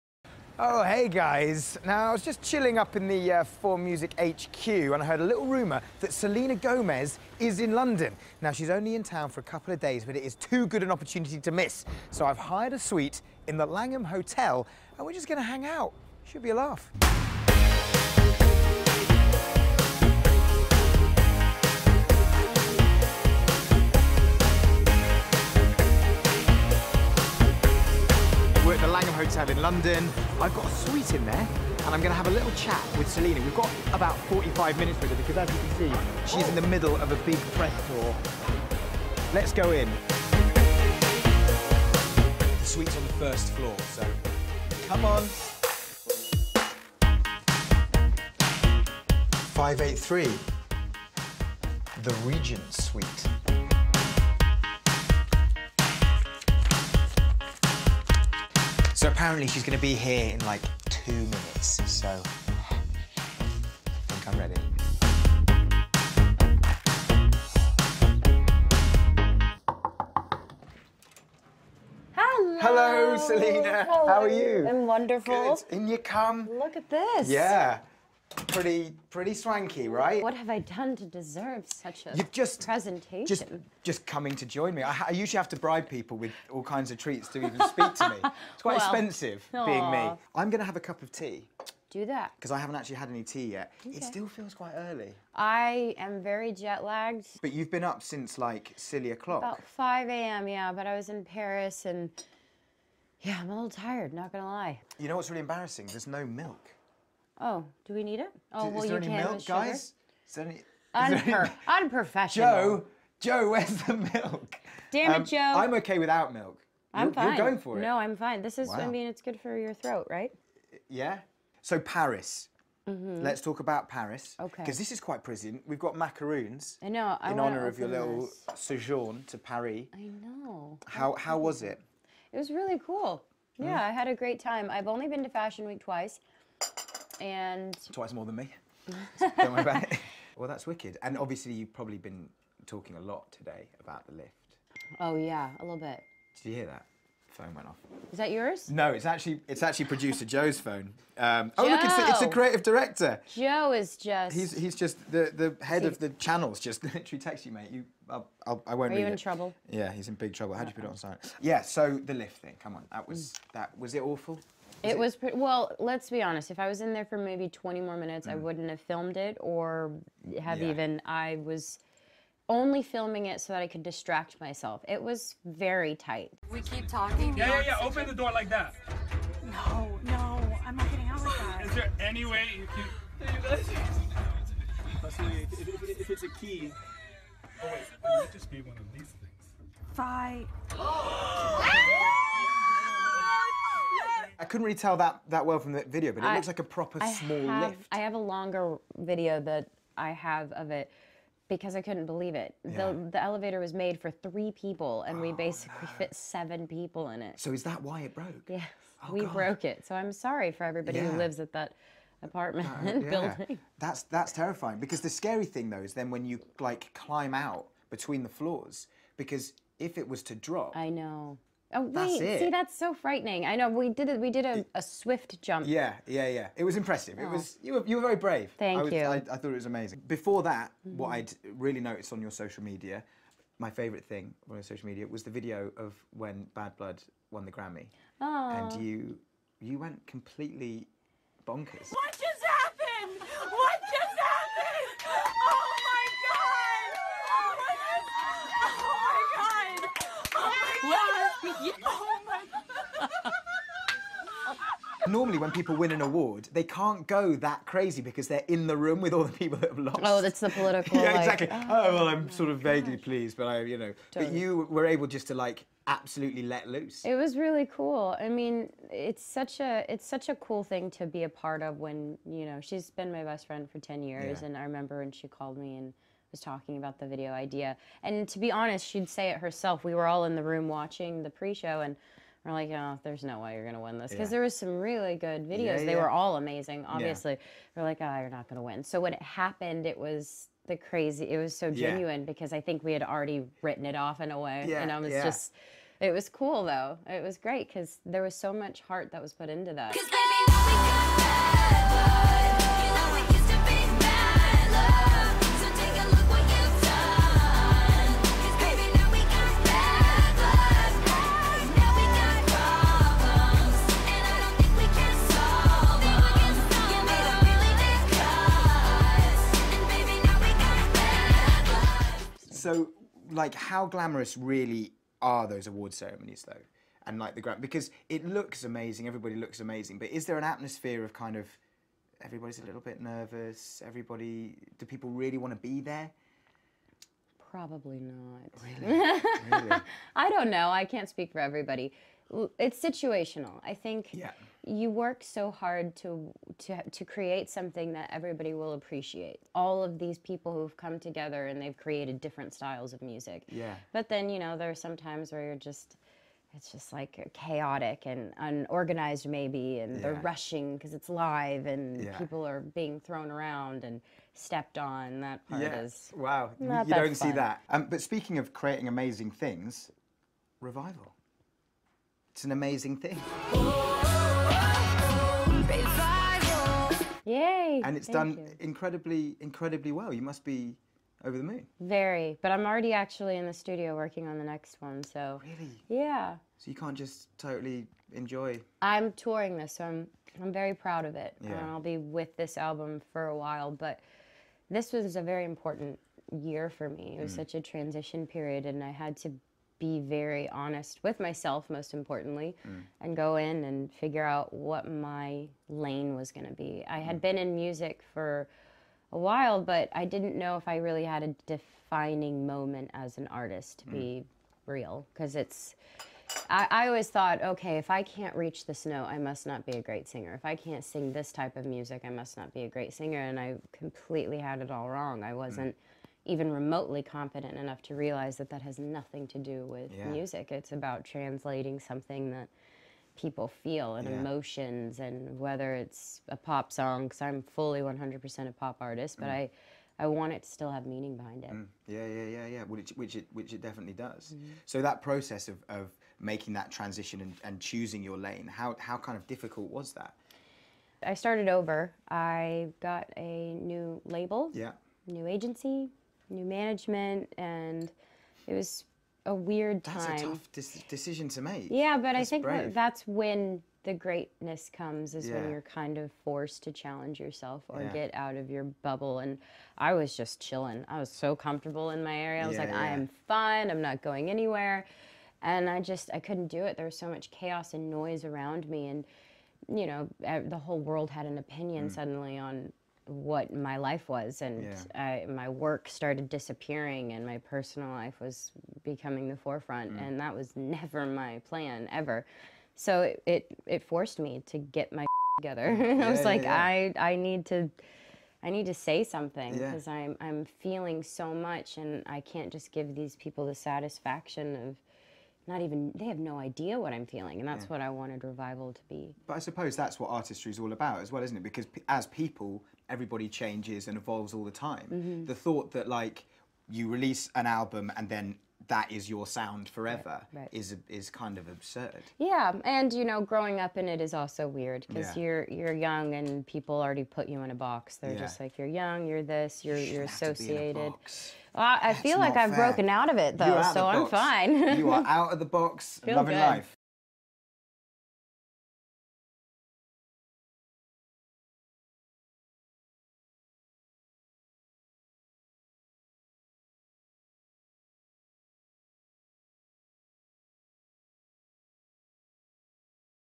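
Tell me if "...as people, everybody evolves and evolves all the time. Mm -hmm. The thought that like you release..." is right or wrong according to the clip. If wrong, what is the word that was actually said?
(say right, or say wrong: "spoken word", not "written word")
wrong: "changes", not "evolves".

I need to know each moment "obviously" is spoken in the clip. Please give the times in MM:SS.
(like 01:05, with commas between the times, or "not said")
02:21, 04:46.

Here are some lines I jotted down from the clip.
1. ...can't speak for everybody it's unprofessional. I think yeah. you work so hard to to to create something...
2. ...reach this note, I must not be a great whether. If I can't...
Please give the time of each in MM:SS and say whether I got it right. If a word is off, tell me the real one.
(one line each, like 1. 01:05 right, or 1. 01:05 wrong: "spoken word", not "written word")
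1. 05:40 wrong: "situational", not "unprofessional"
2. 06:58 wrong: "singer", not "whether".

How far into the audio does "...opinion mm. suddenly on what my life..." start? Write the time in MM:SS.
08:01.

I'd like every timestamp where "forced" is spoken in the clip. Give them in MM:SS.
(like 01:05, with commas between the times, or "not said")
07:46, 08:13.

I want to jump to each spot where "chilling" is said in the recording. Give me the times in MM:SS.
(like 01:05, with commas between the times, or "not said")
00:02, 07:50.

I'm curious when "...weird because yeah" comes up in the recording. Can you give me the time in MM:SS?
08:44.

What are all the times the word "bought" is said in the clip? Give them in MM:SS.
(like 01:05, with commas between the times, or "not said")
not said.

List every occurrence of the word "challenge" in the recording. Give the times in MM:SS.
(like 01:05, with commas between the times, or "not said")
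07:46.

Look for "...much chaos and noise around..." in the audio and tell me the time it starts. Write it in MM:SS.
07:57.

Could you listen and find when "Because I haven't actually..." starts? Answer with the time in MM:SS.
01:32.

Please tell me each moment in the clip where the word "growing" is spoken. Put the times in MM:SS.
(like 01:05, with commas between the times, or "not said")
08:43.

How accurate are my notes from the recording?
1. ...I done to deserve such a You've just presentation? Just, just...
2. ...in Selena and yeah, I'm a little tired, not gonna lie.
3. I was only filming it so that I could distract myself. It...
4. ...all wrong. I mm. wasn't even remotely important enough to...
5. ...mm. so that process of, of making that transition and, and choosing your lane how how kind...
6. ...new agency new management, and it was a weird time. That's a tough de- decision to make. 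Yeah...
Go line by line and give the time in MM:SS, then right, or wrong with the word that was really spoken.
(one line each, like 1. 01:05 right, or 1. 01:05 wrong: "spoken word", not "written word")
1. 01:20 right
2. 01:41 wrong: "Paris", not "Selena"
3. 02:51 right
4. 07:04 wrong: "confident", not "important"
5. 07:24 right
6. 07:35 right.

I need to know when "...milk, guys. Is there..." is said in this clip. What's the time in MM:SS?
01:49.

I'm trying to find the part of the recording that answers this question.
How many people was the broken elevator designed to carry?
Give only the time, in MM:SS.
03:24.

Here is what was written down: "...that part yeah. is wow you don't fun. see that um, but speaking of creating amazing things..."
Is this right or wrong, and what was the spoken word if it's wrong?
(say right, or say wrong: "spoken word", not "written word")
right.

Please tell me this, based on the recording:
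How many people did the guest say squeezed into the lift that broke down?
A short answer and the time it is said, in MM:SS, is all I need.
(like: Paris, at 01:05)
7, at 03:26.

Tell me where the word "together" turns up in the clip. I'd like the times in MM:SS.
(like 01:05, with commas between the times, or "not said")
05:50, 08:15.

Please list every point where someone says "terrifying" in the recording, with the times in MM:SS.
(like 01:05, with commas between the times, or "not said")
03:34.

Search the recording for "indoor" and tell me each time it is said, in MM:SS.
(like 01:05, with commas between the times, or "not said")
not said.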